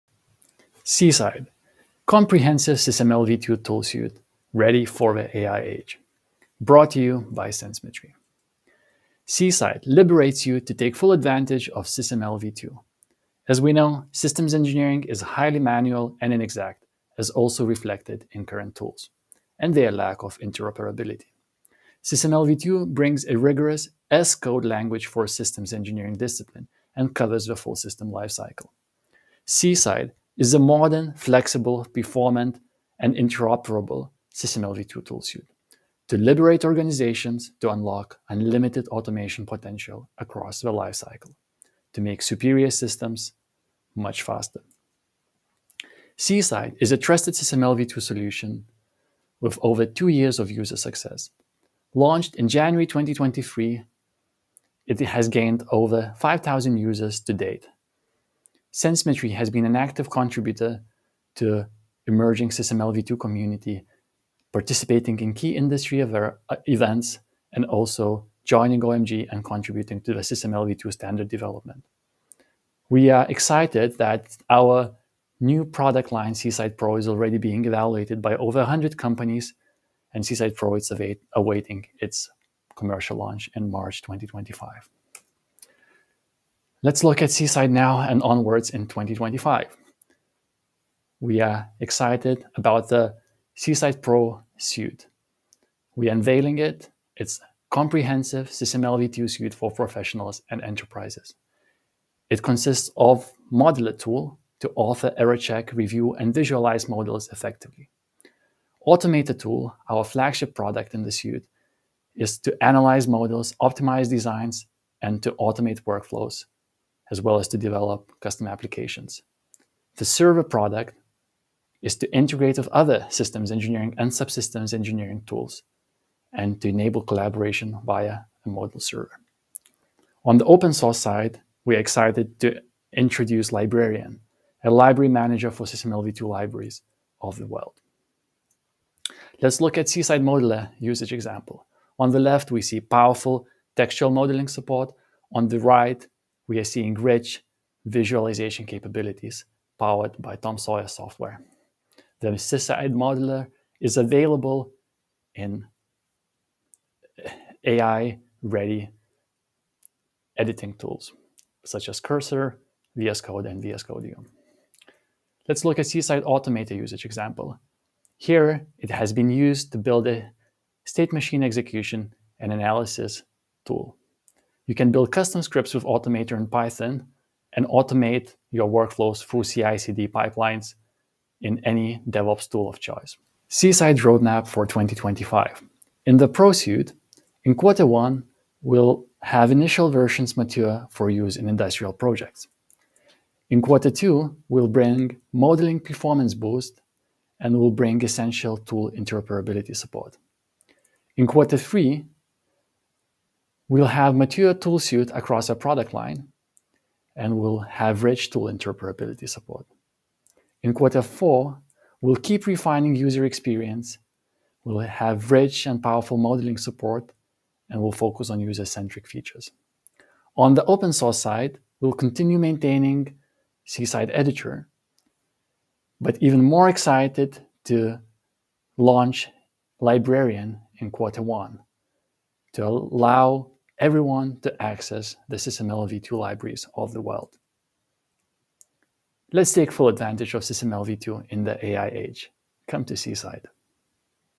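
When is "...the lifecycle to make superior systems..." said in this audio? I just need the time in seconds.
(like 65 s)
40 s.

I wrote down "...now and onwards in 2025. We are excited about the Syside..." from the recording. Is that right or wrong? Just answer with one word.
right.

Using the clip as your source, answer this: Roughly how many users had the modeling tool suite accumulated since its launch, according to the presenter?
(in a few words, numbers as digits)
5,000.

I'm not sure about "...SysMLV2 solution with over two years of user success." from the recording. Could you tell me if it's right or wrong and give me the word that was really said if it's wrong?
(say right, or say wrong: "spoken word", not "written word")
right.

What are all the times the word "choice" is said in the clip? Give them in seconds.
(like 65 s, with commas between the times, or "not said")
182 s.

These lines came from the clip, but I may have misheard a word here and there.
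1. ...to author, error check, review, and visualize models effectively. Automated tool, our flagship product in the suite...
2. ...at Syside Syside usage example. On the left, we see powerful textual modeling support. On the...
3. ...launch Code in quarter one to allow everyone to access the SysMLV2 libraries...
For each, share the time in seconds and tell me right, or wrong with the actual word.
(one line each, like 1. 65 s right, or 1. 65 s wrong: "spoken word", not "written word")
1. 104 s right
2. 139 s wrong: "Modeler", not "Syside"
3. 228 s wrong: "Librarian", not "Code".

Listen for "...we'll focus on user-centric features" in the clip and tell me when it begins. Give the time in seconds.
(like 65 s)
217 s.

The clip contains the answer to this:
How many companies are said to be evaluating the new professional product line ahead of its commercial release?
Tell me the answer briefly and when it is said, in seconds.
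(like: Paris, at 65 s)
100, at 78 s.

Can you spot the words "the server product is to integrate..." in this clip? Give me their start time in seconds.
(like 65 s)
119 s.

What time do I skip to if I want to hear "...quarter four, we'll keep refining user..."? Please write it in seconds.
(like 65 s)
210 s.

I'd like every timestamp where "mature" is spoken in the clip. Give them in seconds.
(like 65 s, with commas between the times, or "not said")
190 s, 204 s.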